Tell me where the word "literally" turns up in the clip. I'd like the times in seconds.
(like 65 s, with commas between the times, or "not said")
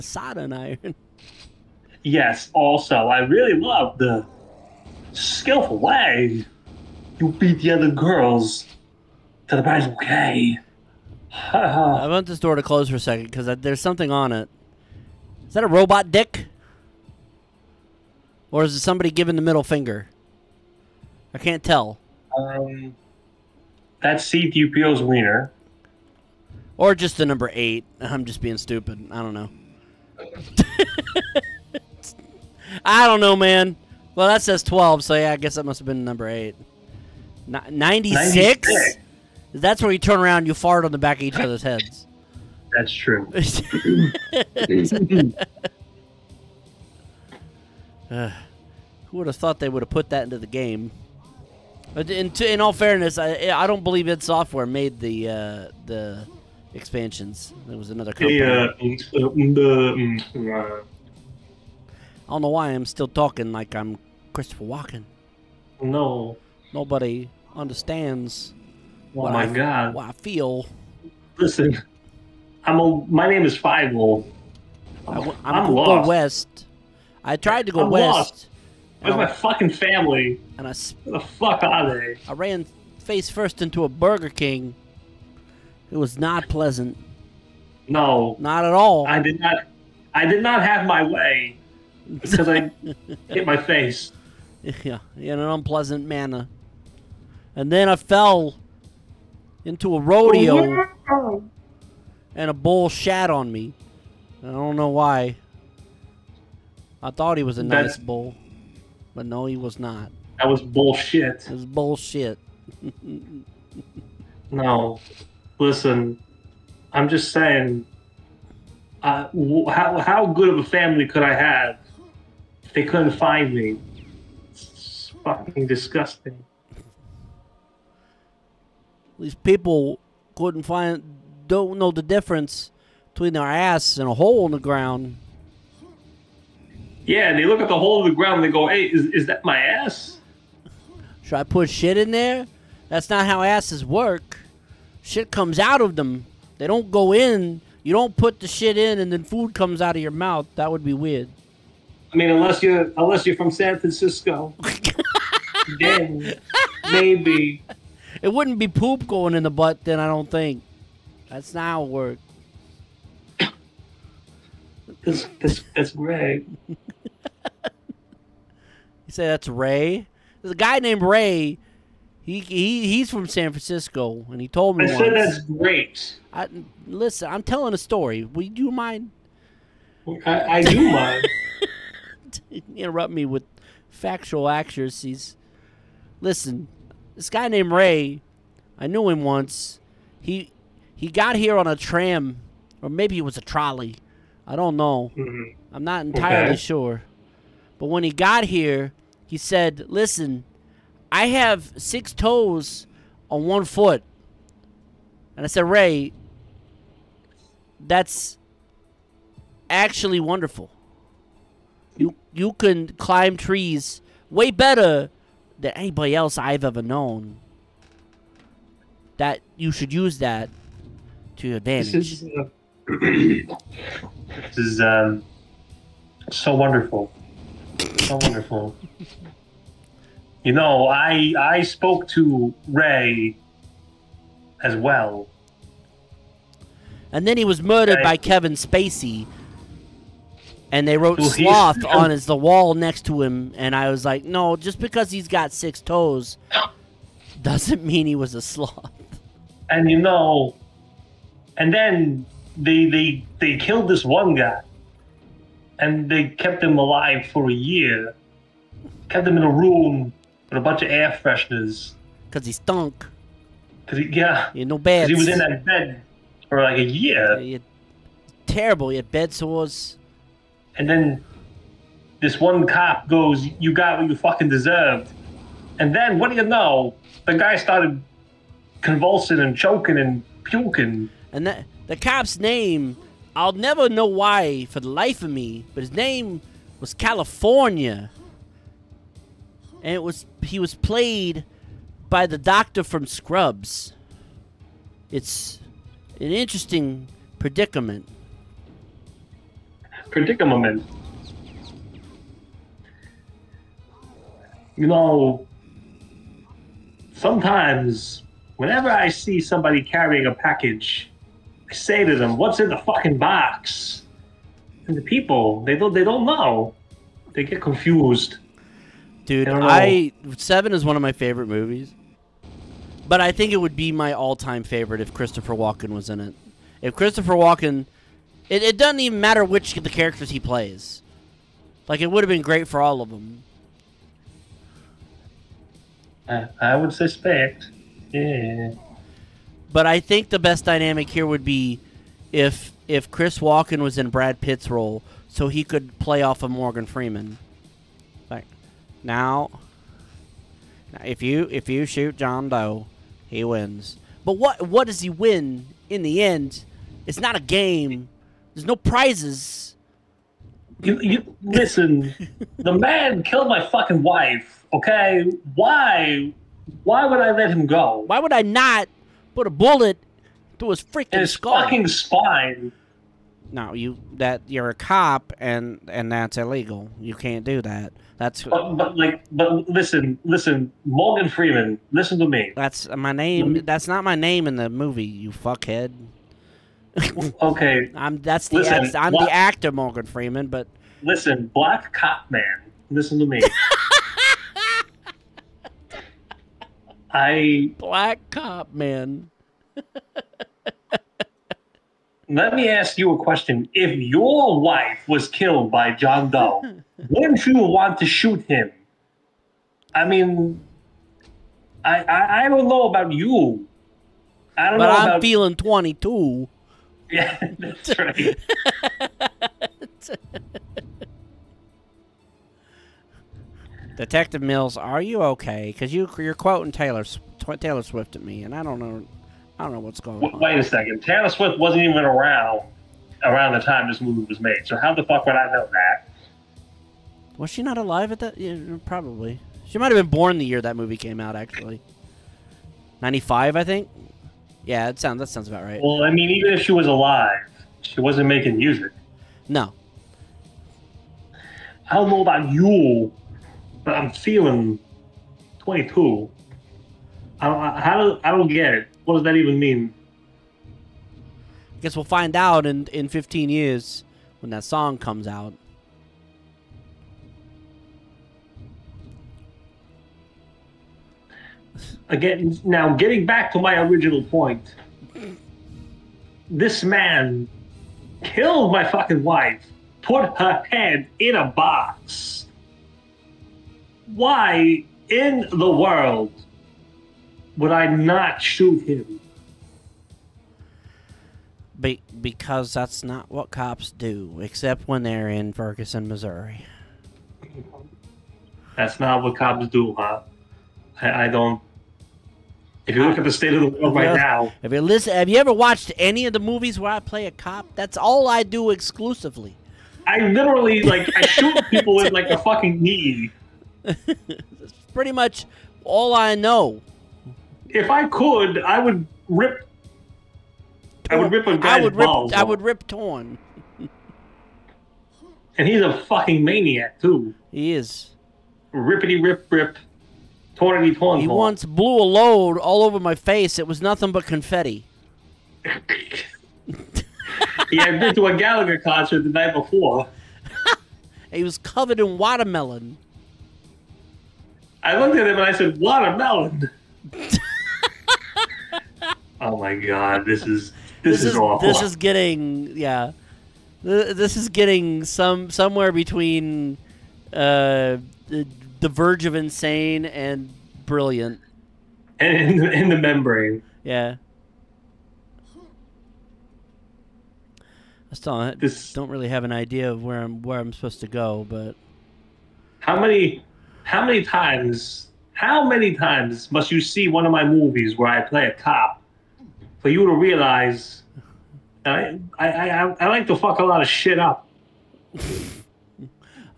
510 s.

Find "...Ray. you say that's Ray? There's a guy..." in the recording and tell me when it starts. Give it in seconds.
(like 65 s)
165 s.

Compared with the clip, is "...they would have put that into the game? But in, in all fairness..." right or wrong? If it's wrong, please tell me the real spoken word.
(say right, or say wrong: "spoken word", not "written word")
right.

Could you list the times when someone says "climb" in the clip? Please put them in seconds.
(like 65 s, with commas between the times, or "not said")
212 s.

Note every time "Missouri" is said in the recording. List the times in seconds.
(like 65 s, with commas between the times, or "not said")
496 s.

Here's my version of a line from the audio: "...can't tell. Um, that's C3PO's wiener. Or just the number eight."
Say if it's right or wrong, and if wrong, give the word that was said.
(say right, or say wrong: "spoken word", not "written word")
right.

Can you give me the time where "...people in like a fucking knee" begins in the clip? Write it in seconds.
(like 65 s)
511 s.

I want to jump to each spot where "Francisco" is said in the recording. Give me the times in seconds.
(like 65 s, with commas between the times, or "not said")
153 s, 173 s.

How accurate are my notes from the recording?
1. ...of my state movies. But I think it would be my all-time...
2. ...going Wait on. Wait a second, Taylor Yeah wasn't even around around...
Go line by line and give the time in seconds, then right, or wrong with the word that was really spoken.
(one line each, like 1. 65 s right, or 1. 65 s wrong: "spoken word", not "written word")
1. 320 s wrong: "favorite", not "state"
2. 430 s wrong: "Swift", not "Yeah".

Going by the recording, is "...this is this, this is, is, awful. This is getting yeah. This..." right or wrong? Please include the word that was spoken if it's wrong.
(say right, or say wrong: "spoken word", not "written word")
right.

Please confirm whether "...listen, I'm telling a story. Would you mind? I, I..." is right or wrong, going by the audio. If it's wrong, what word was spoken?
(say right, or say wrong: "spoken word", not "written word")
right.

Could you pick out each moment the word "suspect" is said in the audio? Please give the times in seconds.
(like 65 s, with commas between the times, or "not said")
336 s.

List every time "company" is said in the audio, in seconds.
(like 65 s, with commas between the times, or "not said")
58 s.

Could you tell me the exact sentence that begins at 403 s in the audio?
If your wife was killed by John Doe, wouldn't you want to shoot him?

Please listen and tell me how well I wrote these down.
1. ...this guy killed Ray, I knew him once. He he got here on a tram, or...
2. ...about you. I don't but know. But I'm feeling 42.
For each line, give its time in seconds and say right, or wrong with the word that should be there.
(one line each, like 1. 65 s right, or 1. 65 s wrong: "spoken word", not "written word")
1. 187 s wrong: "named", not "killed"
2. 412 s wrong: "22", not "42".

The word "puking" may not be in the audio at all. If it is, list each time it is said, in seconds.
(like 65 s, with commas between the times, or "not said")
280 s.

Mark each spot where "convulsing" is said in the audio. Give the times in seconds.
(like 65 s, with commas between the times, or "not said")
278 s.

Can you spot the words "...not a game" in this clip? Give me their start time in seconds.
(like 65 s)
357 s.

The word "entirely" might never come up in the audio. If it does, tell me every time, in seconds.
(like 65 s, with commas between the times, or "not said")
196 s.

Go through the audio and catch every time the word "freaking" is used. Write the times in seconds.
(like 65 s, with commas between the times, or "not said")
370 s.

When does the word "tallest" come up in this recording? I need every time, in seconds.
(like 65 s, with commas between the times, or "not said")
not said.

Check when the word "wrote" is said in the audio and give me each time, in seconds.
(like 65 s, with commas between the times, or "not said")
240 s.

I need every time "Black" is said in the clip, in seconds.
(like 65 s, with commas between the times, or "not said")
391 s, 397 s.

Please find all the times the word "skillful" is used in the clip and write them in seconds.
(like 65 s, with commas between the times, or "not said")
5 s.